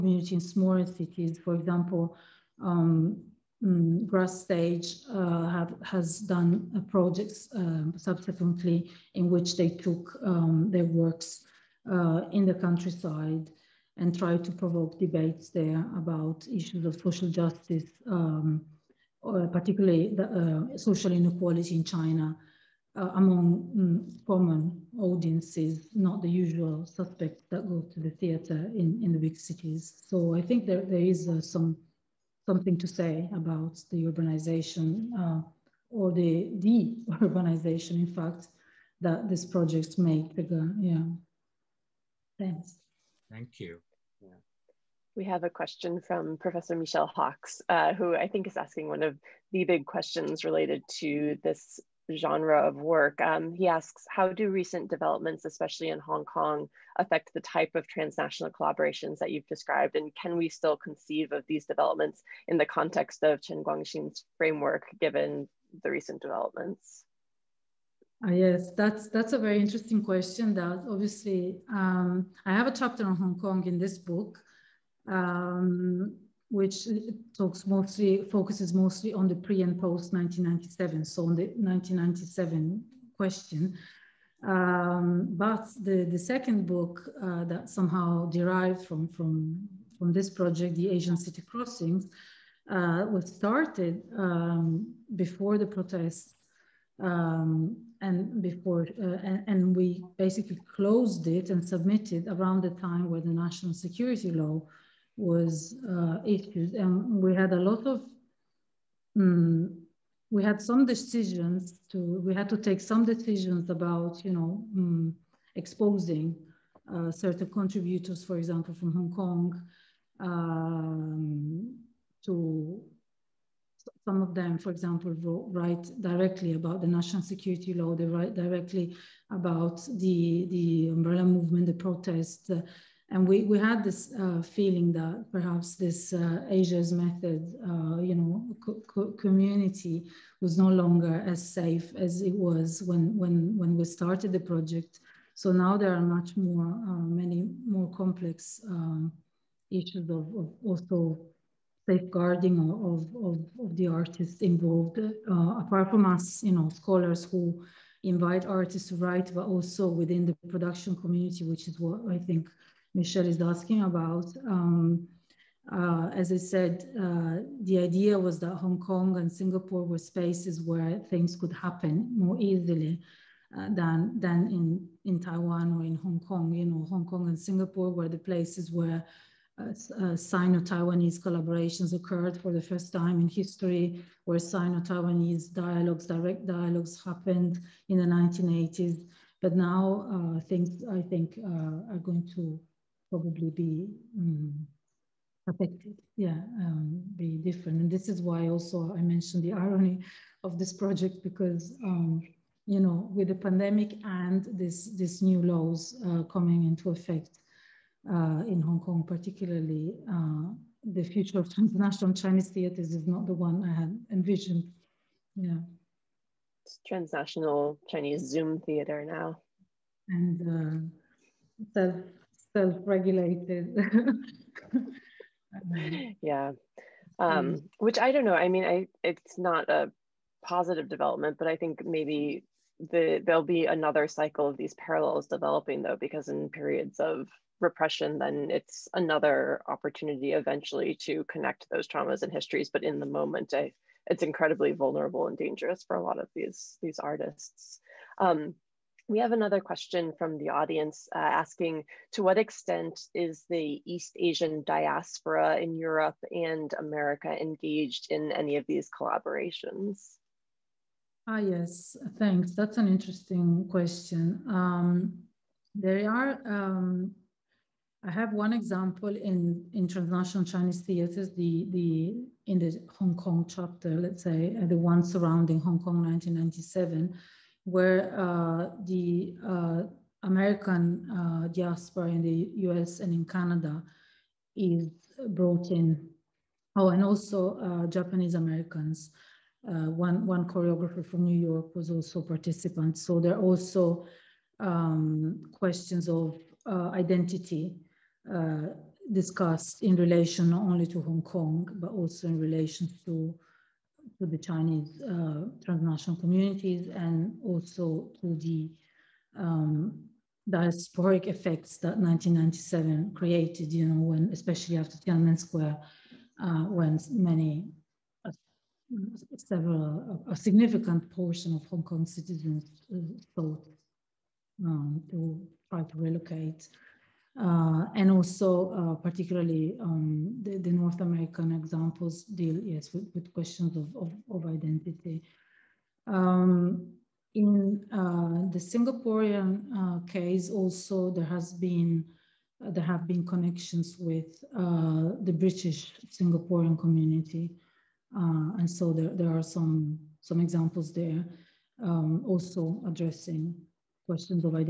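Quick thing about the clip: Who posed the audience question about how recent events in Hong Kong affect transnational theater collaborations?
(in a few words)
Michel Hockx.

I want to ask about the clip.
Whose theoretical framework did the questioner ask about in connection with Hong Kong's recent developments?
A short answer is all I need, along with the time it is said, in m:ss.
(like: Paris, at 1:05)
Chen Kuan-Hsing, at 1:03.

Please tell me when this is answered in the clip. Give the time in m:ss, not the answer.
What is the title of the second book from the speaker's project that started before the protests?
1:30.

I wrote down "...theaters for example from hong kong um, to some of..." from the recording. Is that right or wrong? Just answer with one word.
wrong.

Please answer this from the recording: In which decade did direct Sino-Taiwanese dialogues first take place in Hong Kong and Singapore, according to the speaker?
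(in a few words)
1980s.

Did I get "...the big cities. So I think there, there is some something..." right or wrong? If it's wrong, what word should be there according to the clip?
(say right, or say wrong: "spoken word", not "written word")
right.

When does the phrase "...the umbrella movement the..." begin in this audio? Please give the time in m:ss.
2:10.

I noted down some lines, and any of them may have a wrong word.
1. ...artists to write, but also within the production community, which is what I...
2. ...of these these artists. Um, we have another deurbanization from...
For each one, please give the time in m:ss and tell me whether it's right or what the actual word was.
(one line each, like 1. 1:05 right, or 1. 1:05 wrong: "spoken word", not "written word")
1. 2:38 right
2. 4:06 wrong: "question", not "deurbanization".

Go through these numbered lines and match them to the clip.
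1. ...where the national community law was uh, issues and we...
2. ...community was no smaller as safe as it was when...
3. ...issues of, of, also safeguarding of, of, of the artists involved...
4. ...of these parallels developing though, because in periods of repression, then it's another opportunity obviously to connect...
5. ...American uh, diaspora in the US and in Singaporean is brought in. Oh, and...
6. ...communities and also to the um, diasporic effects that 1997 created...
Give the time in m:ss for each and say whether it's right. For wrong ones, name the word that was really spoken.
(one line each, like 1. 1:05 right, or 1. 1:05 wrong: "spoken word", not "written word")
1. 1:43 wrong: "security", not "community"
2. 2:19 wrong: "longer", not "smaller"
3. 2:29 right
4. 3:54 wrong: "eventually", not "obviously"
5. 4:40 wrong: "Canada", not "Singaporean"
6. 5:06 right.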